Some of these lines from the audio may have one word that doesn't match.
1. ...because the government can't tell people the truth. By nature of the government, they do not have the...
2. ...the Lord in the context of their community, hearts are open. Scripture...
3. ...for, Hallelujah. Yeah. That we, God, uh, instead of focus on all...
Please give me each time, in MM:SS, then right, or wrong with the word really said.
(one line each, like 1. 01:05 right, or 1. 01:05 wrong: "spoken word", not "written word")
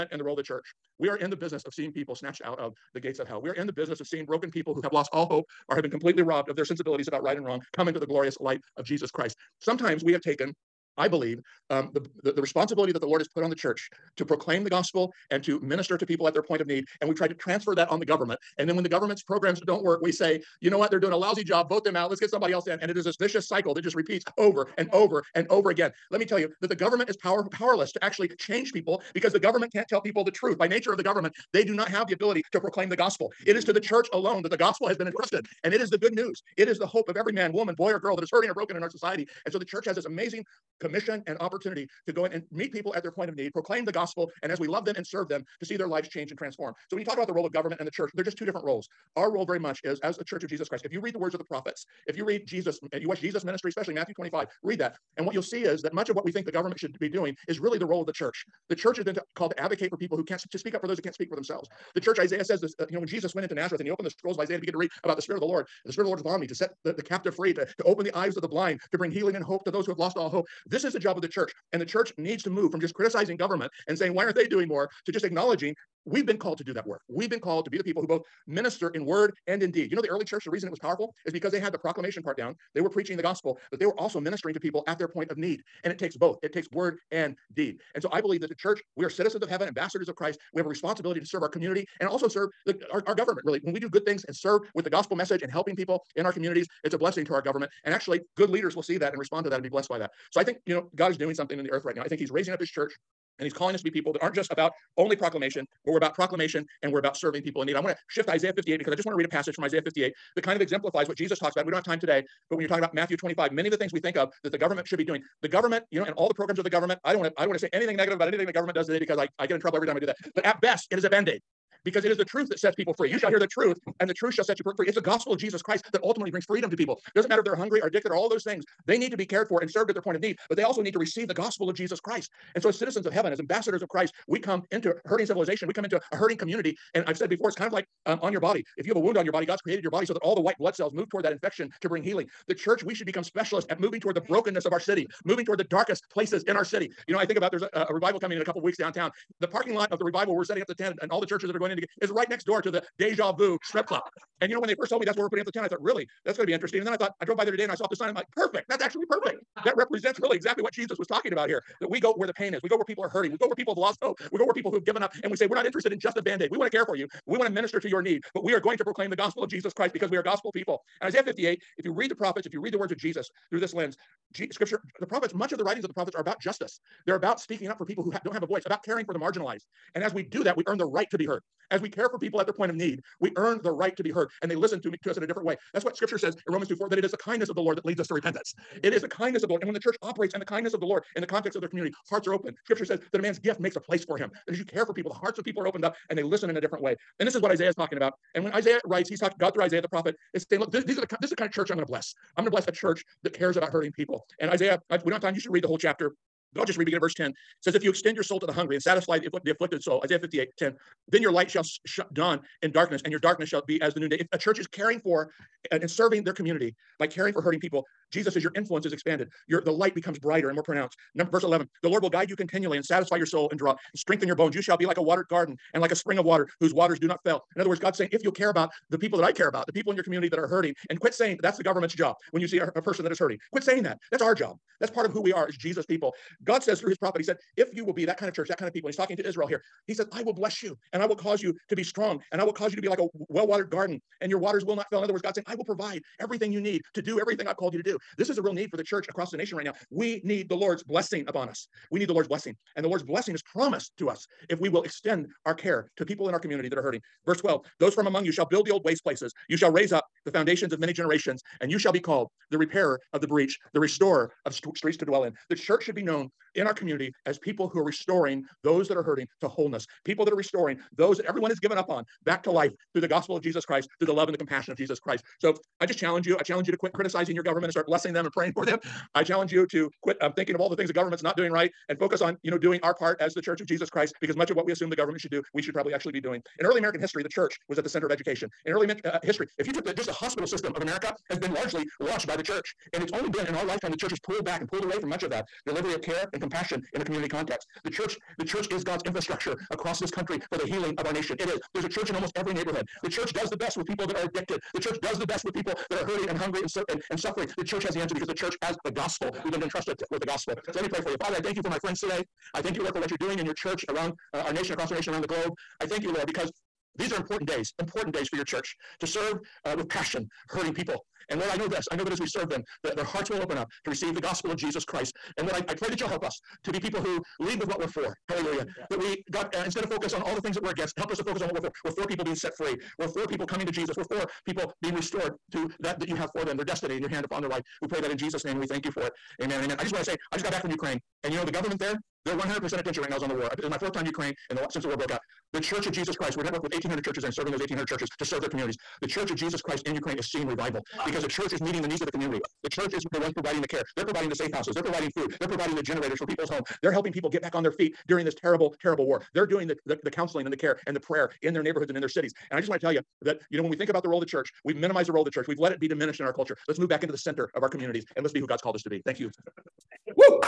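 1. 00:29 right
2. 03:10 right
3. 05:27 right.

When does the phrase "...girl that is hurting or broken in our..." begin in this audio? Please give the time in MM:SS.
00:37.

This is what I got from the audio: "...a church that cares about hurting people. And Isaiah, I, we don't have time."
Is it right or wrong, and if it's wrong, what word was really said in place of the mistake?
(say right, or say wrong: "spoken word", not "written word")
right.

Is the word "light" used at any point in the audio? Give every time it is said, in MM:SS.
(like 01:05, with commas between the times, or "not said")
00:08, 03:31, 03:39.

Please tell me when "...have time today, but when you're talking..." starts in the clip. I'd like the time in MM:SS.
01:51.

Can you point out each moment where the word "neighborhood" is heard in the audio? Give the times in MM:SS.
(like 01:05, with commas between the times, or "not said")
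05:02, 06:01.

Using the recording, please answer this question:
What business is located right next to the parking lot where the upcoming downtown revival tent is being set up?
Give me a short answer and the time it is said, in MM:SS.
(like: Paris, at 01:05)
Deja vu strip club, at 02:32.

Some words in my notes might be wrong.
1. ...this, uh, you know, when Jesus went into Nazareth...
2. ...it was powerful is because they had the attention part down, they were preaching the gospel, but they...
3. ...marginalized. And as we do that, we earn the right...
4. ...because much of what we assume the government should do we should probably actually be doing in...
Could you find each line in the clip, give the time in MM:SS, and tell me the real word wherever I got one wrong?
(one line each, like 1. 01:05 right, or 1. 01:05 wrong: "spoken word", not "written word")
1. 01:02 right
2. 01:20 wrong: "proclamation", not "attention"
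3. 02:59 right
4. 04:44 right.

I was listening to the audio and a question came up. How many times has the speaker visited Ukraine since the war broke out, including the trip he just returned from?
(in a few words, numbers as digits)
4.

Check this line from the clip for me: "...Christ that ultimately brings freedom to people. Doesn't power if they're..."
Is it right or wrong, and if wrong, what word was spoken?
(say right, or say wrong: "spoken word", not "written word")
wrong: "matter", not "power".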